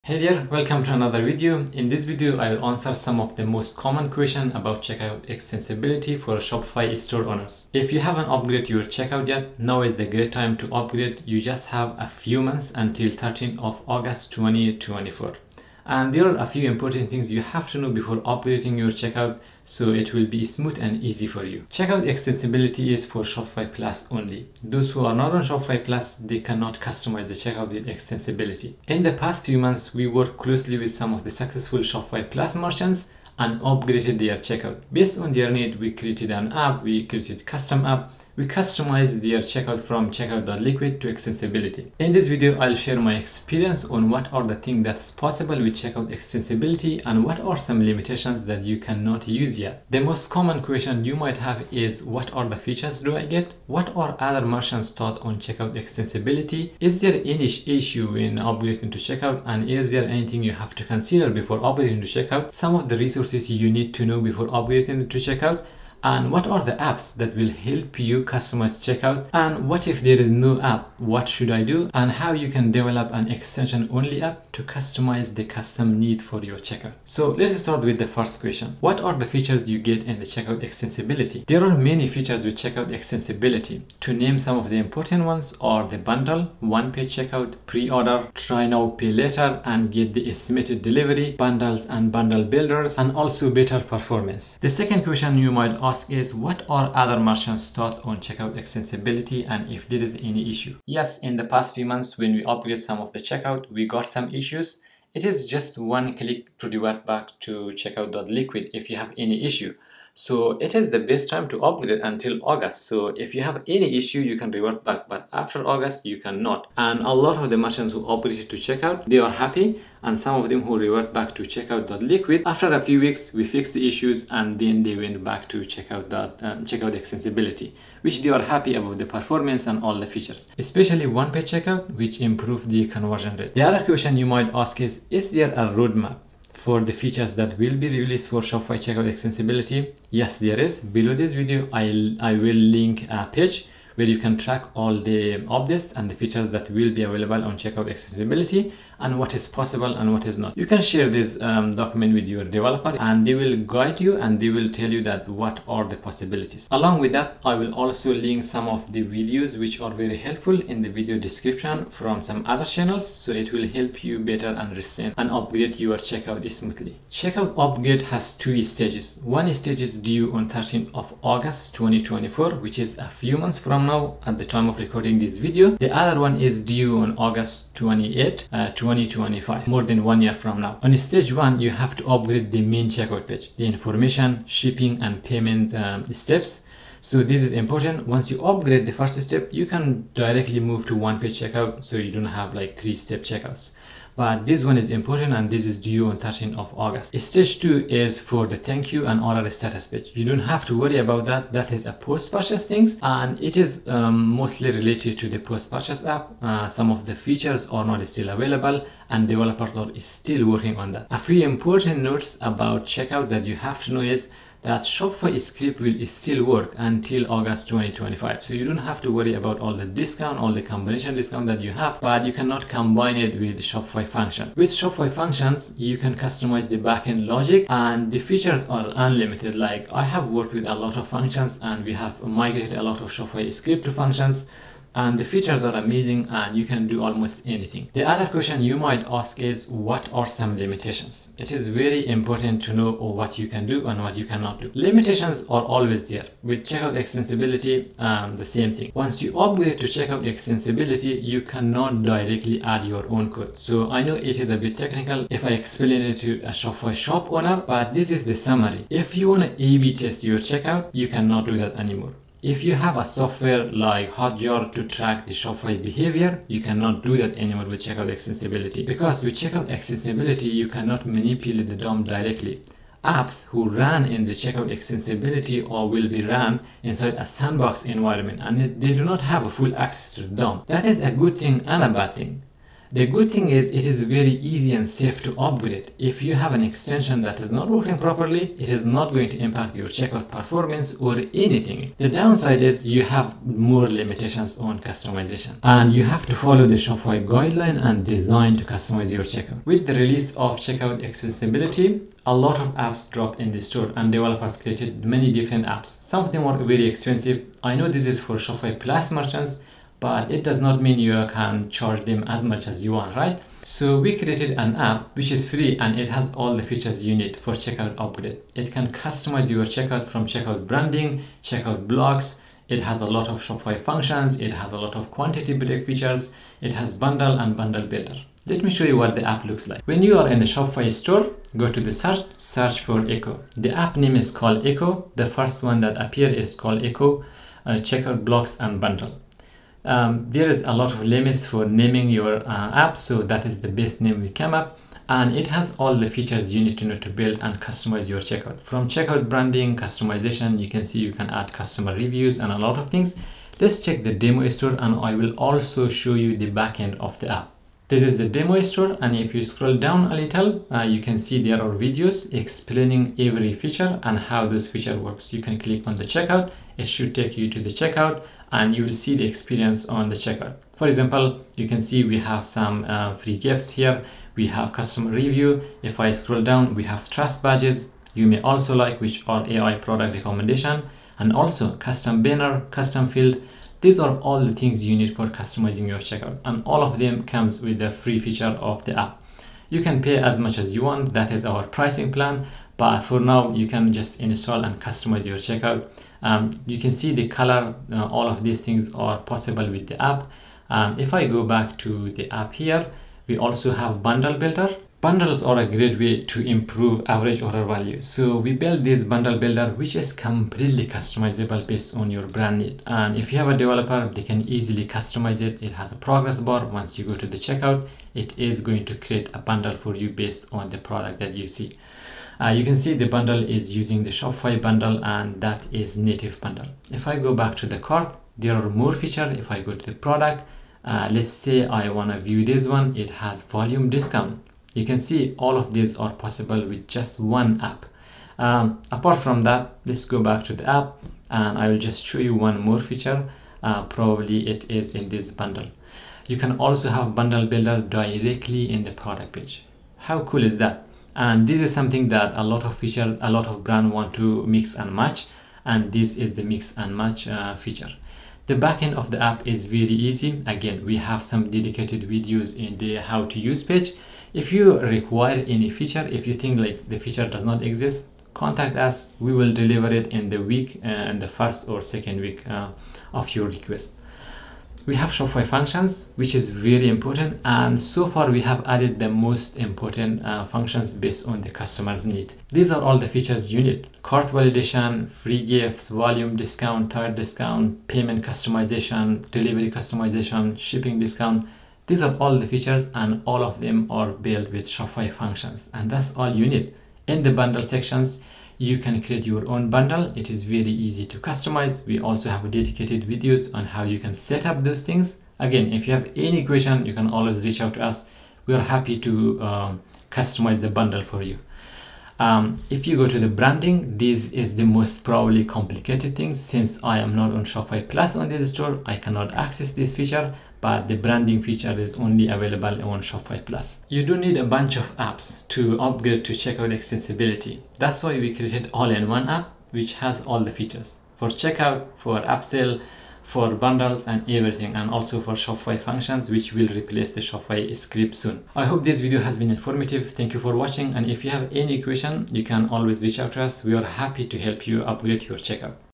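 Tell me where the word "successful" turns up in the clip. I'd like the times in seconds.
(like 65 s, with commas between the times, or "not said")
31 s.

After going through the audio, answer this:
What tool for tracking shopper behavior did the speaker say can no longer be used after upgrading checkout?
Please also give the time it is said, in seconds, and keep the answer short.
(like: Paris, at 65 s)
Hotjar, at 264 s.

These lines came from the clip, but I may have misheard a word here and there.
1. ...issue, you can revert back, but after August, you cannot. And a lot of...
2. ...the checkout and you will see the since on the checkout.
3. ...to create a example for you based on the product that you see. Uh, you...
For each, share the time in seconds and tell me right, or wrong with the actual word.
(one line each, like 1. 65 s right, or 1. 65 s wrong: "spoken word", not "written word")
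1. 113 s right
2. 367 s wrong: "experience", not "since"
3. 418 s wrong: "bundle", not "example".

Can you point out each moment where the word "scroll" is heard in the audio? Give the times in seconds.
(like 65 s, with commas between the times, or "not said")
359 s, 376 s.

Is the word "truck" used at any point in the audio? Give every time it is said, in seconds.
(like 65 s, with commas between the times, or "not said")
not said.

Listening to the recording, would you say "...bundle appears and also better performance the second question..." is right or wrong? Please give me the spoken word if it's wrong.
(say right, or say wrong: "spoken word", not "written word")
wrong: "builders", not "appears".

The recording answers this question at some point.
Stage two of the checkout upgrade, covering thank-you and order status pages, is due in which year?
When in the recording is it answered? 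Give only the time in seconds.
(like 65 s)
178 s.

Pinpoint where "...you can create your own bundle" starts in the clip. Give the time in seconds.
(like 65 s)
498 s.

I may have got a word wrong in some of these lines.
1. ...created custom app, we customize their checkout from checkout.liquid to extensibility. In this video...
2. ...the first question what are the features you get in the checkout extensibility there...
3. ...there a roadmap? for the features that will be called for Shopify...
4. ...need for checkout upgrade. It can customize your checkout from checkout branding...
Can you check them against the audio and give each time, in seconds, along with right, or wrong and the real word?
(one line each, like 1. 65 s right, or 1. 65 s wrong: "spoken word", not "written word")
1. 37 s right
2. 77 s right
3. 135 s wrong: "released", not "called"
4. 317 s right.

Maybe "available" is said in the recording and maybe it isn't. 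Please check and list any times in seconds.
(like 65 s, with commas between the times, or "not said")
147 s, 208 s, 522 s.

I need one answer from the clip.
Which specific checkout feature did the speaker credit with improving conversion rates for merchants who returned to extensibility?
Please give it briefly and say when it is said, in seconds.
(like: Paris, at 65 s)
one-page checkout, at 131 s.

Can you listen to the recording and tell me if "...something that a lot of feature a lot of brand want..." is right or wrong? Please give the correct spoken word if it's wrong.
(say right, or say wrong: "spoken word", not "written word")
right.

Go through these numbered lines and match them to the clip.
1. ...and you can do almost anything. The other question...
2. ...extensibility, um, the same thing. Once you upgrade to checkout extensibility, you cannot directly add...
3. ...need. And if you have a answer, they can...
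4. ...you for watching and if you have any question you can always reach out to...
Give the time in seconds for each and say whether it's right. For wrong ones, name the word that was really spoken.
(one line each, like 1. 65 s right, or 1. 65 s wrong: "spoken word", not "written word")
1. 236 s right
2. 246 s right
3. 412 s wrong: "developer", not "answer"
4. 540 s right.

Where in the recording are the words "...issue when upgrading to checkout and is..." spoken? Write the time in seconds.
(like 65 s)
57 s.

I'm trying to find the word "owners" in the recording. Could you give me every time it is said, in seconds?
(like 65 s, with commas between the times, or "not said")
7 s, 257 s.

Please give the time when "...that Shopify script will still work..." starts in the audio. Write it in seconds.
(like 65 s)
214 s.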